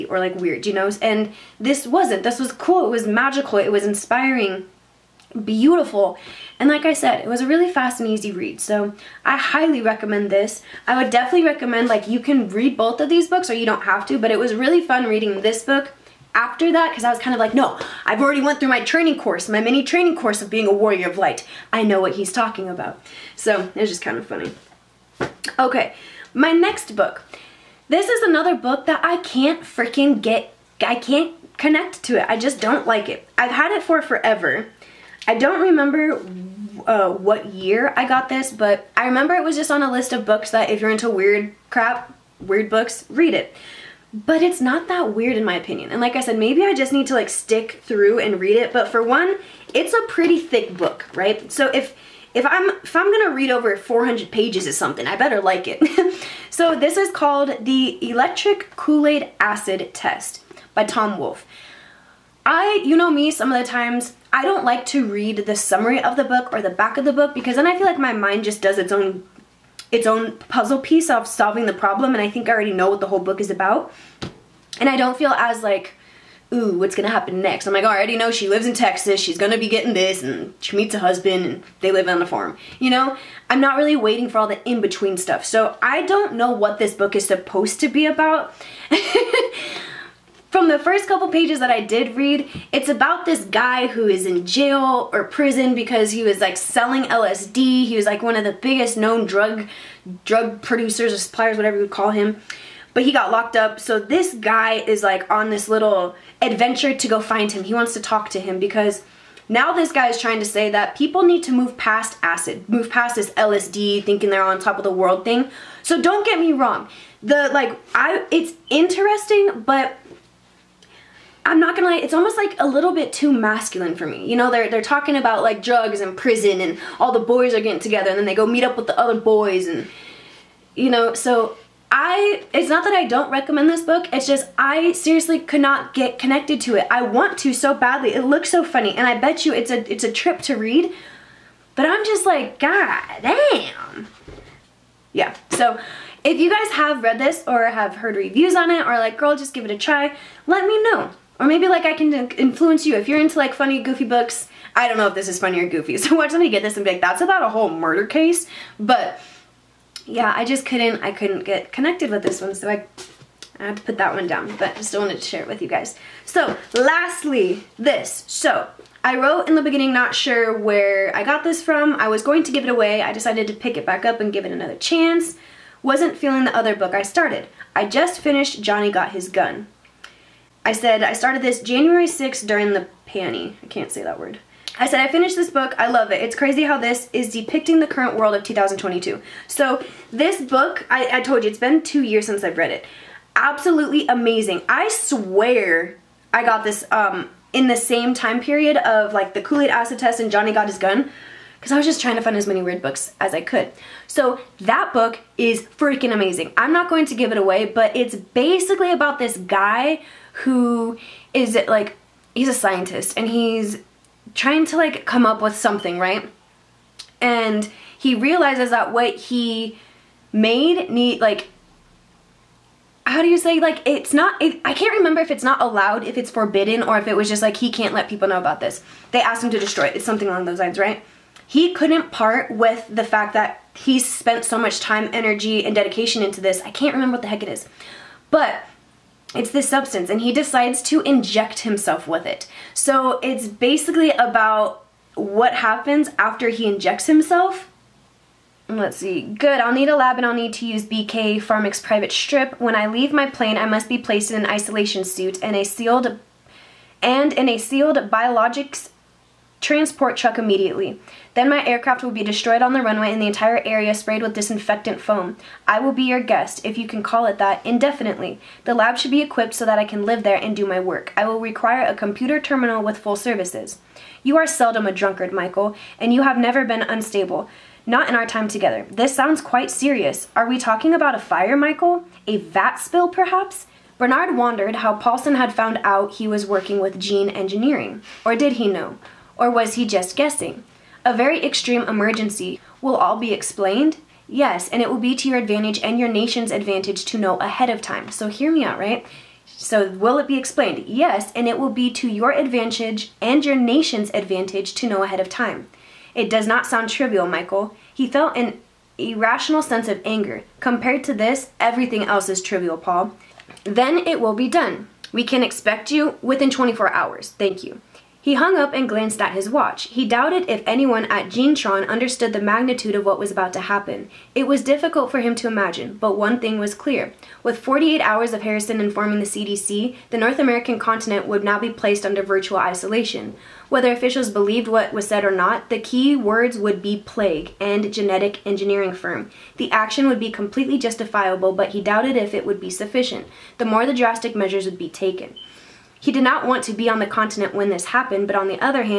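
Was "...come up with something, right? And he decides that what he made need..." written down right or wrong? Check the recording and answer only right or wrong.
wrong.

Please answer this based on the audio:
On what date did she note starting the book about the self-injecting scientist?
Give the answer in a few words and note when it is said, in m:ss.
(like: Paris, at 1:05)
January 6th, at 3:01.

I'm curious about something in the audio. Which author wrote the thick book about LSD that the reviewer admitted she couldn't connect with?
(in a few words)
Tom Wolfe.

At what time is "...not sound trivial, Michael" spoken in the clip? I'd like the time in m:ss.
5:06.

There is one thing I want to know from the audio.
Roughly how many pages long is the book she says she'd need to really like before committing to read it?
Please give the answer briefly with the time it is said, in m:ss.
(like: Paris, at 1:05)
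400, at 0:53.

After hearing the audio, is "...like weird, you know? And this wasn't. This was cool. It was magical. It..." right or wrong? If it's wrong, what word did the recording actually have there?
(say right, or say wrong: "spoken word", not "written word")
right.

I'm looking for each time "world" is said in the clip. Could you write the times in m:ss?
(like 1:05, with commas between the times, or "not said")
1:54, 3:08.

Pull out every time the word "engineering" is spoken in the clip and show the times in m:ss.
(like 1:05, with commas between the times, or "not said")
4:47, 5:38.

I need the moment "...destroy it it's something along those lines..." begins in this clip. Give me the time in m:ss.
3:49.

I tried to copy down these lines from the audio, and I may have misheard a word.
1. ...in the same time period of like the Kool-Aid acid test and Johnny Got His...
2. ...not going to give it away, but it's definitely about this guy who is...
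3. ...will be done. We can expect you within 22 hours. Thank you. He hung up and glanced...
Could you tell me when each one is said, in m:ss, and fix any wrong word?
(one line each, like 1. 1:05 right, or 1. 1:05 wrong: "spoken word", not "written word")
1. 3:17 right
2. 3:26 wrong: "basically", not "definitely"
3. 5:14 wrong: "24", not "22".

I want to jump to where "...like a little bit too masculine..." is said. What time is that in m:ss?
2:02.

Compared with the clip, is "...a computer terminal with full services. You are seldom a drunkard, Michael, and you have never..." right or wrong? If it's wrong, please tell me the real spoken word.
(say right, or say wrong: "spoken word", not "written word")
right.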